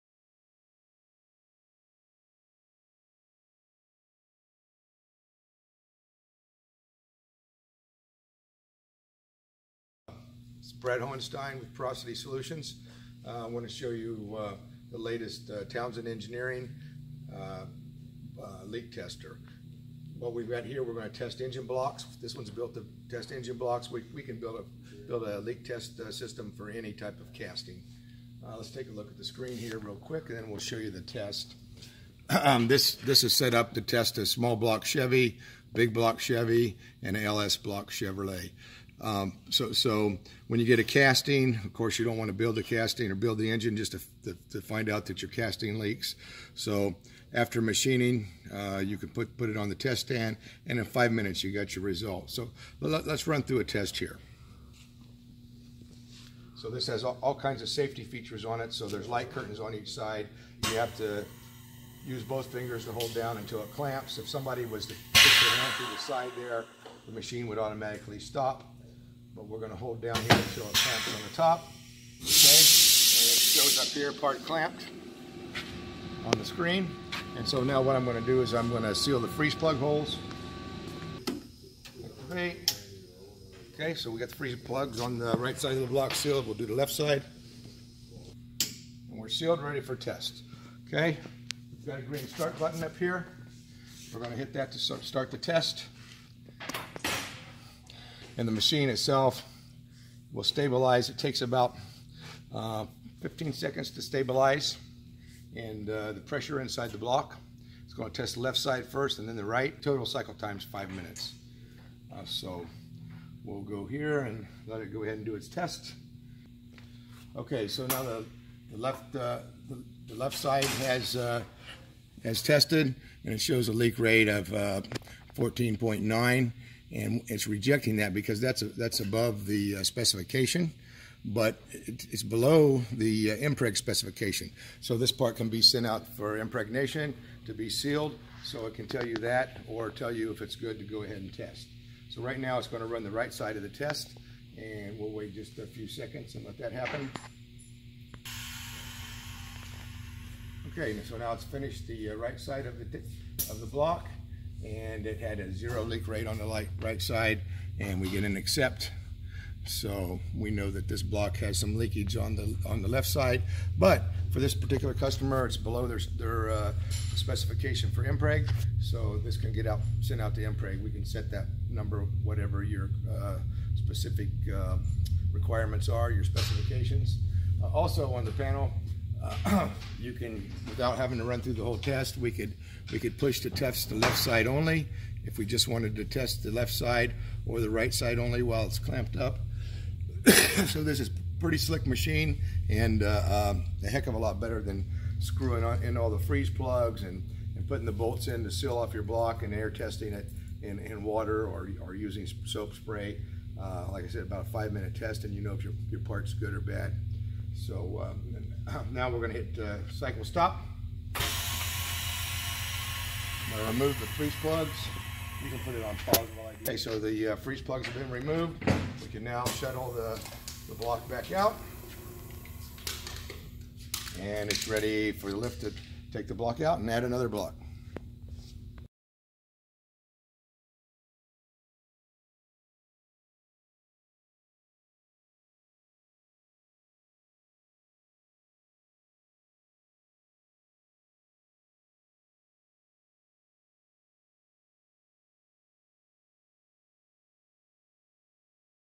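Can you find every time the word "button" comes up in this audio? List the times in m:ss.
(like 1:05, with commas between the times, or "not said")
1:32.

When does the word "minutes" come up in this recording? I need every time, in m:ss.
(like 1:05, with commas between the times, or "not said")
0:51, 1:50, 3:24.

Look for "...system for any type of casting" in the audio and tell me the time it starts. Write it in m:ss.
0:26.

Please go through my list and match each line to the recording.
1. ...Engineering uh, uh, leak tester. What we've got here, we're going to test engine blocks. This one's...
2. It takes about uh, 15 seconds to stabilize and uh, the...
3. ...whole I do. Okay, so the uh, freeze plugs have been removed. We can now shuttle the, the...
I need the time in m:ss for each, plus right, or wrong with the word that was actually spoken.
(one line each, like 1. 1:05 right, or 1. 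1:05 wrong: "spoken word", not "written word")
1. 0:16 right
2. 1:41 right
3. 3:36 wrong: "while", not "whole".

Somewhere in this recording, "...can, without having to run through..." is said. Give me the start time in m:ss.
3:00.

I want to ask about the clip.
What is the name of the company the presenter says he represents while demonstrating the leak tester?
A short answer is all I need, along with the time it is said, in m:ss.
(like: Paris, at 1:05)
Porosity Solutions, at 0:11.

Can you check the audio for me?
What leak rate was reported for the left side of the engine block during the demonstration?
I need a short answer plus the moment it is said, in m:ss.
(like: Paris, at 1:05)
14.9, at 2:04.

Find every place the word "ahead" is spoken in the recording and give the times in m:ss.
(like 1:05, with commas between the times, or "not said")
1:55, 2:21.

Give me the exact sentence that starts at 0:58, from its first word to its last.
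So there's light curtains on each side.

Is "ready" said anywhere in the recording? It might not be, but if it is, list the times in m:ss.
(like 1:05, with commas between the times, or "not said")
1:29, 3:44.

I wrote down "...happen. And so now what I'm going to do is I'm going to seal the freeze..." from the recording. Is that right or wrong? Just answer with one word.
wrong.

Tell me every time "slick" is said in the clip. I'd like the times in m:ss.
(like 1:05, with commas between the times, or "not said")
3:11.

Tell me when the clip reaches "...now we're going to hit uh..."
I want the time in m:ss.
3:28.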